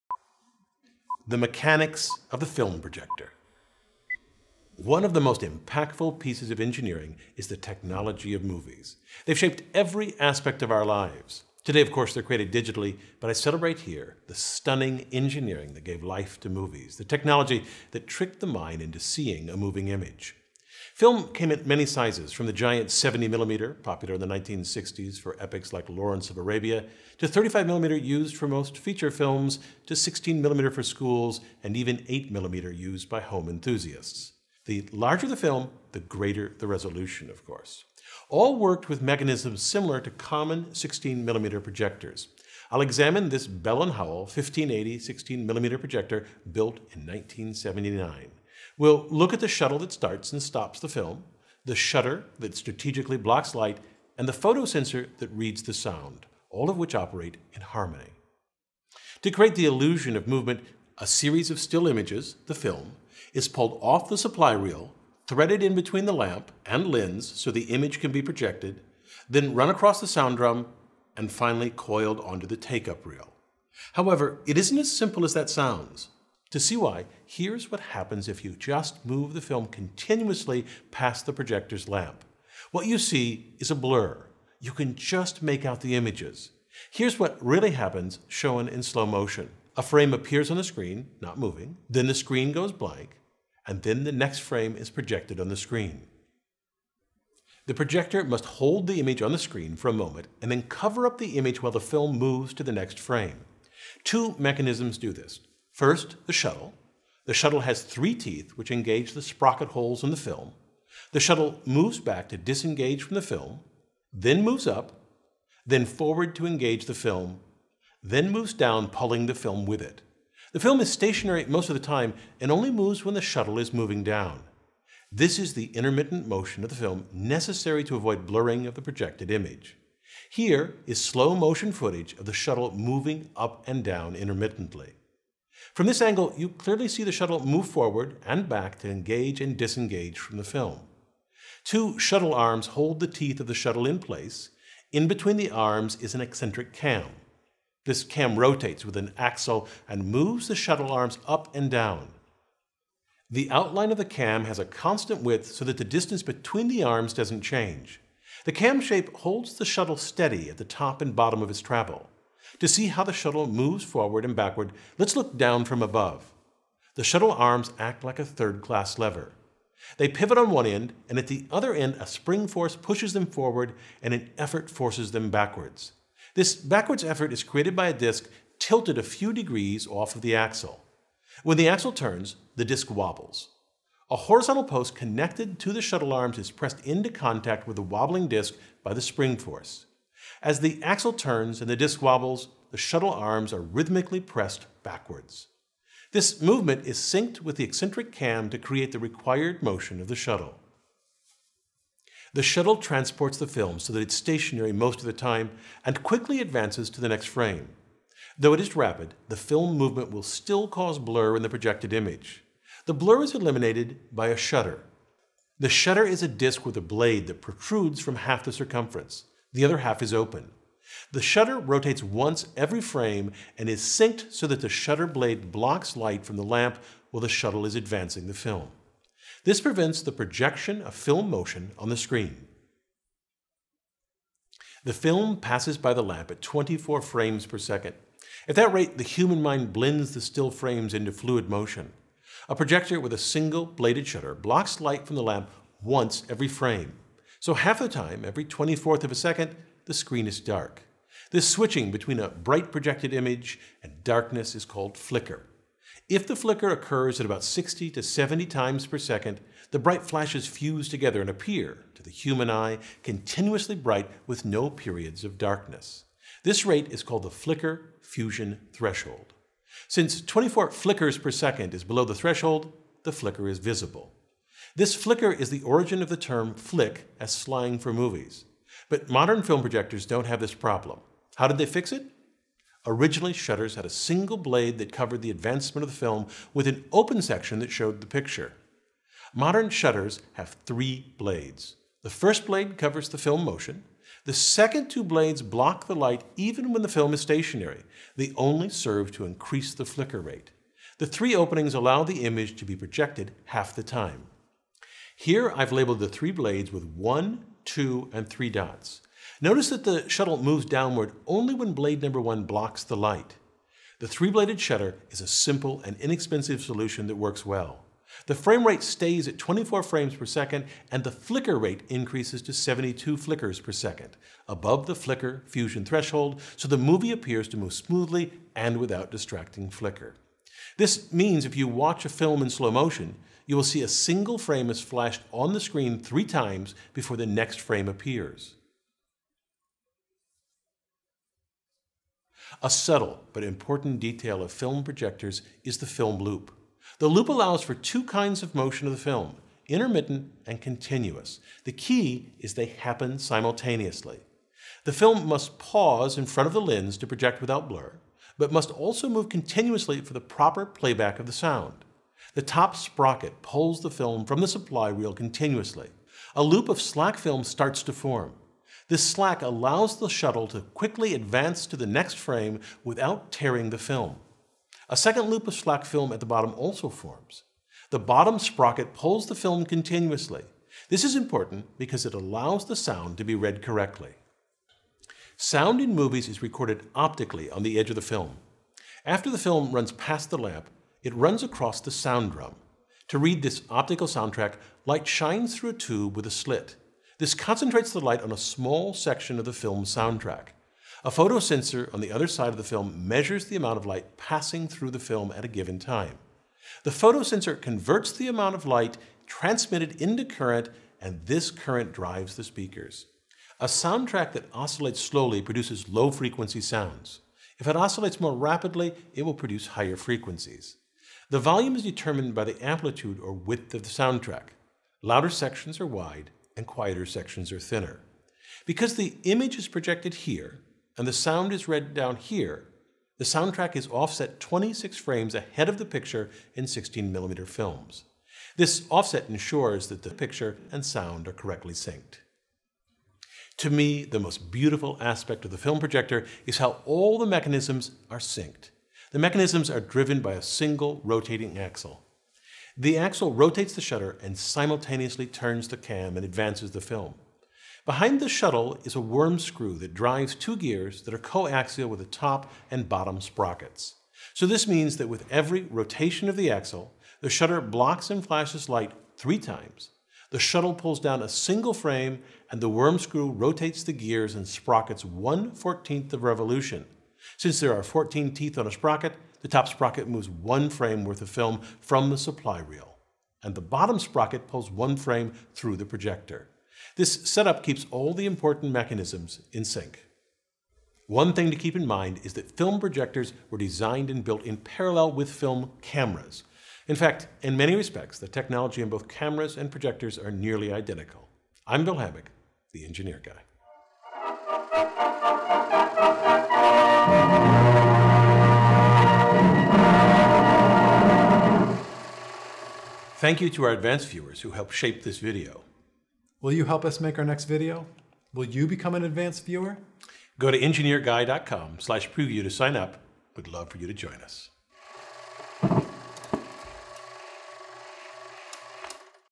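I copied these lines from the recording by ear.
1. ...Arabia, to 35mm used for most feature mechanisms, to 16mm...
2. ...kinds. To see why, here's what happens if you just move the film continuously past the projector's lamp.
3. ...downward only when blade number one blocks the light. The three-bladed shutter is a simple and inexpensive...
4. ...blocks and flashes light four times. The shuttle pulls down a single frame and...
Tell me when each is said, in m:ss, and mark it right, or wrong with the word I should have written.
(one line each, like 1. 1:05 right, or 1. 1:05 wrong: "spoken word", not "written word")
1. 0:26 wrong: "films", not "mechanisms"
2. 1:15 wrong: "sounds", not "kinds"
3. 5:10 right
4. 7:47 wrong: "three", not "four".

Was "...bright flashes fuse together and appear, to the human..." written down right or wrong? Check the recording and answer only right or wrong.
right.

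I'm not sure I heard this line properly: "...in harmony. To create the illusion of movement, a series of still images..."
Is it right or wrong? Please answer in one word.
right.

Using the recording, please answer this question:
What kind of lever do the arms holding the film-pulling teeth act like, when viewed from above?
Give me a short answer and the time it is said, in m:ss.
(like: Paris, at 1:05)
third-class lever, at 2:48.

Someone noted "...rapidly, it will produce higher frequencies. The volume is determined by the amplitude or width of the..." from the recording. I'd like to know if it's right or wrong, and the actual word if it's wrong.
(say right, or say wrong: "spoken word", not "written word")
right.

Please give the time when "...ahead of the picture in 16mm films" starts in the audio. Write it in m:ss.
7:15.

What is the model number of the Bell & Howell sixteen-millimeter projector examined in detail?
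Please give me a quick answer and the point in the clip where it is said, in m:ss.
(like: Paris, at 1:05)
1580, at 0:44.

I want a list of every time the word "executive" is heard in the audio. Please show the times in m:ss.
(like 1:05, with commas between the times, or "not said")
not said.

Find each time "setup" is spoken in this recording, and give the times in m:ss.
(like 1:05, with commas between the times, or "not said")
8:07.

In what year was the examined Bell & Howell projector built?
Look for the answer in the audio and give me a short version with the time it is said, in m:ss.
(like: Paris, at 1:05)
1979, at 0:47.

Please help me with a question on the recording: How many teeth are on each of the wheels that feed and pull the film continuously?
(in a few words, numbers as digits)
14.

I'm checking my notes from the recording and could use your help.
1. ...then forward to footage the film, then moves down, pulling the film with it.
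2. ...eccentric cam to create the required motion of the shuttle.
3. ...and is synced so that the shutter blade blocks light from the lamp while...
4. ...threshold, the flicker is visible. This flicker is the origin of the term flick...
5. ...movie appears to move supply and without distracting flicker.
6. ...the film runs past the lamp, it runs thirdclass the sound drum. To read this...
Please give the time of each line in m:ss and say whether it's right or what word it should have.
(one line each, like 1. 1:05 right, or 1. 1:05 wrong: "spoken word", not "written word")
1. 1:55 wrong: "engage", not "footage"
2. 3:17 right
3. 3:43 right
4. 4:32 right
5. 5:26 wrong: "smoothly", not "supply"
6. 6:29 wrong: "across", not "thirdclass".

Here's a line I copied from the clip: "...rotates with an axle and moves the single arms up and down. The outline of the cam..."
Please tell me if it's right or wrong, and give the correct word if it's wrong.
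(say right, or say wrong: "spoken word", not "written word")
wrong: "shuttle", not "single".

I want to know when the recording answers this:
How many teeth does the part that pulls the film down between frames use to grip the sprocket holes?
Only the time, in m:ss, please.
1:47.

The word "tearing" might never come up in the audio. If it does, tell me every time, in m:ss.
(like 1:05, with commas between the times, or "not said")
6:13.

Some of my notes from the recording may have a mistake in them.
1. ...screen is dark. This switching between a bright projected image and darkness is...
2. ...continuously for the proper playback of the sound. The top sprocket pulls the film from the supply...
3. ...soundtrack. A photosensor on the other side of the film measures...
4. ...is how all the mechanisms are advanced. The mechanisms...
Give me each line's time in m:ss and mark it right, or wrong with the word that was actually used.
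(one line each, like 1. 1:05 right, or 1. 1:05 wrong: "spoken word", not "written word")
1. 4:09 right
2. 5:59 right
3. 6:39 right
4. 7:26 wrong: "synced", not "advanced".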